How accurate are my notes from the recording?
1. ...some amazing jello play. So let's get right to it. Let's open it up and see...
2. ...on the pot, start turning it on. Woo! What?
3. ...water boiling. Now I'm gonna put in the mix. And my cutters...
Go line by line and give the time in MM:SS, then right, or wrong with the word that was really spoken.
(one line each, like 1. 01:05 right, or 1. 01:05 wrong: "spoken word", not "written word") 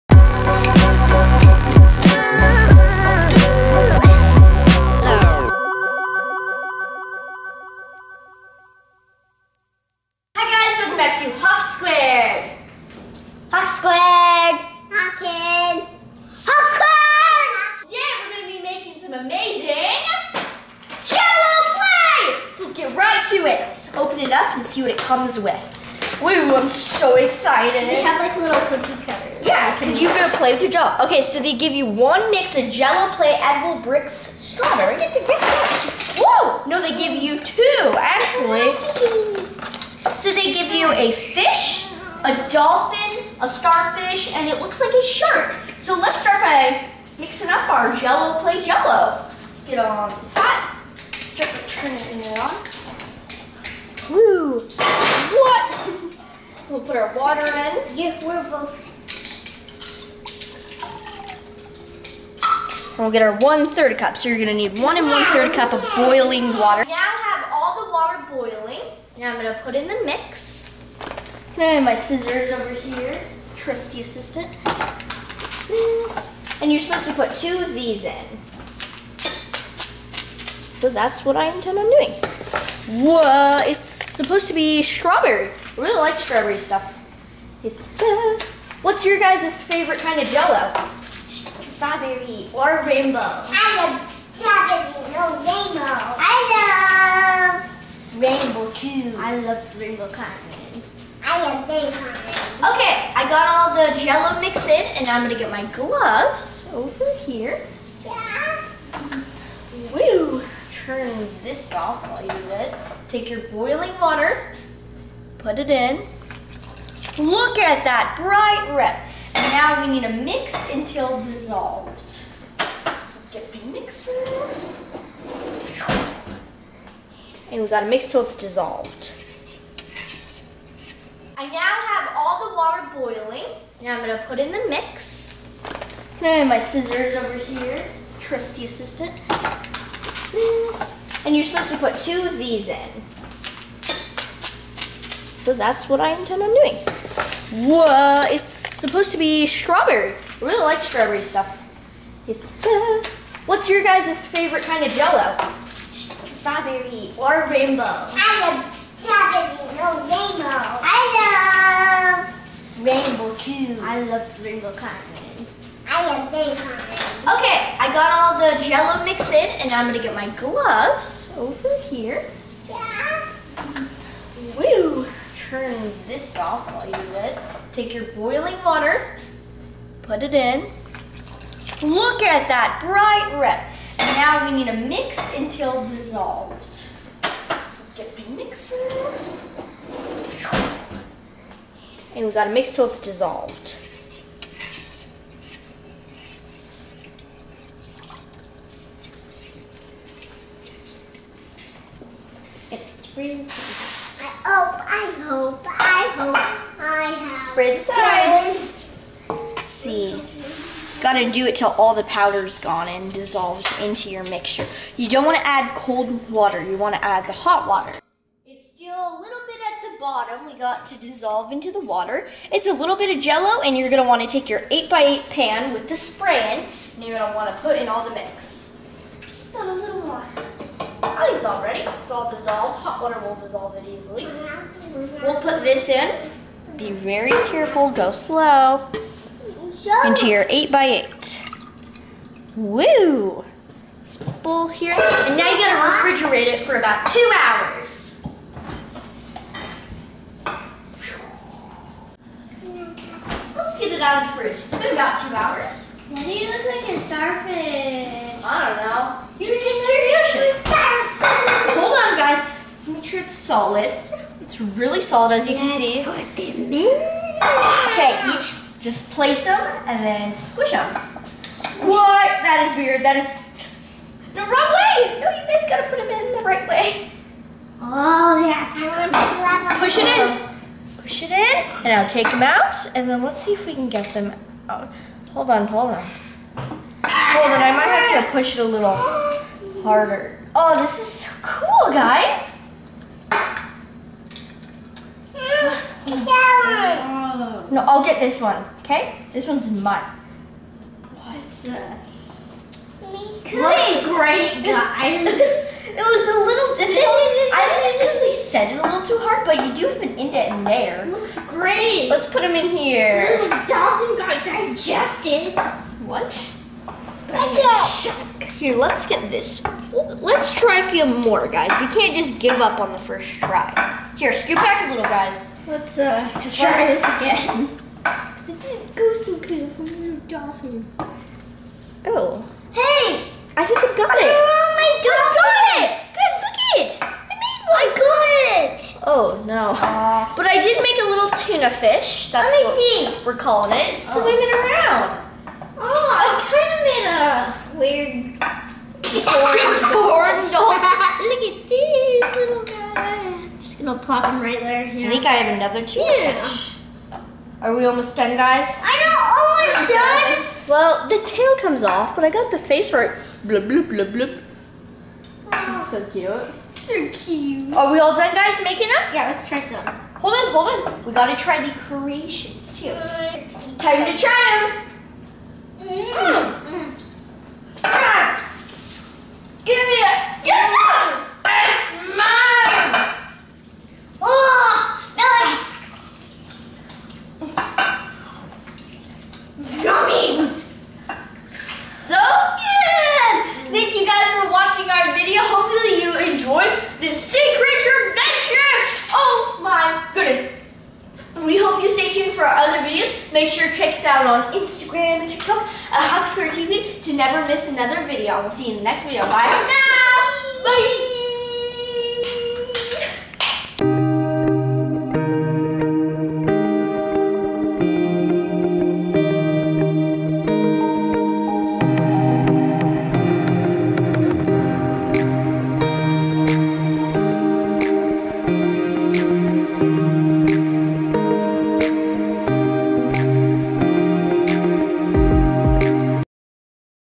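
1. 00:19 right
2. 00:49 right
3. 01:07 wrong: "scissors", not "cutters".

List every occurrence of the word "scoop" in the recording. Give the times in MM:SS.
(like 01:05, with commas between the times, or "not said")
05:24.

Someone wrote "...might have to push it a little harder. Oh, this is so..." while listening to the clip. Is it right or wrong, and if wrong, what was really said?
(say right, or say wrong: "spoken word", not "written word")
right.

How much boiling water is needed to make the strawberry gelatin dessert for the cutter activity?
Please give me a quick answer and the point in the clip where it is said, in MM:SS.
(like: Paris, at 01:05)
1 1/3 cups, at 01:04.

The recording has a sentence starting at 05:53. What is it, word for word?
Just gonna plop him right there.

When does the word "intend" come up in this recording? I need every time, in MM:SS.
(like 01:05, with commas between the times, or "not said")
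01:21, 02:26.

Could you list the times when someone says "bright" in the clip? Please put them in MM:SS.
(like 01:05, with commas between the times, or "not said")
01:58, 03:02.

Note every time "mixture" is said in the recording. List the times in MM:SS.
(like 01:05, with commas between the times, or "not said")
03:34.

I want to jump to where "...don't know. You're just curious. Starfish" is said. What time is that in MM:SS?
04:18.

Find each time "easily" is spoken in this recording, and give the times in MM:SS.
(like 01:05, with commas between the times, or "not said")
03:53.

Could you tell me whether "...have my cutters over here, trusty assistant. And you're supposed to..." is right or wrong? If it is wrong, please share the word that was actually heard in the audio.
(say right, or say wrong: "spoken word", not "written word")
wrong: "scissors", not "cutters".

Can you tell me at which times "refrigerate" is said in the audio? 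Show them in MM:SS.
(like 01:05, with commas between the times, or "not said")
04:05.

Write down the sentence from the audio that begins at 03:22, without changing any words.
It's really I hope, I hope, I hope I have.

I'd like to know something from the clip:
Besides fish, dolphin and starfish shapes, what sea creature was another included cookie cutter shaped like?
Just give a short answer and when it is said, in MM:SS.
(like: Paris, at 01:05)
Shark, at 00:45.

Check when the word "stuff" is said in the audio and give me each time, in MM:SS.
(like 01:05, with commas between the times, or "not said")
01:26, 02:31.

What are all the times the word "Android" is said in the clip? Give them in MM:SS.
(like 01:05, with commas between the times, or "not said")
not said.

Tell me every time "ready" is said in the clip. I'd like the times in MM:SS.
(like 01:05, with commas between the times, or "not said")
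03:51.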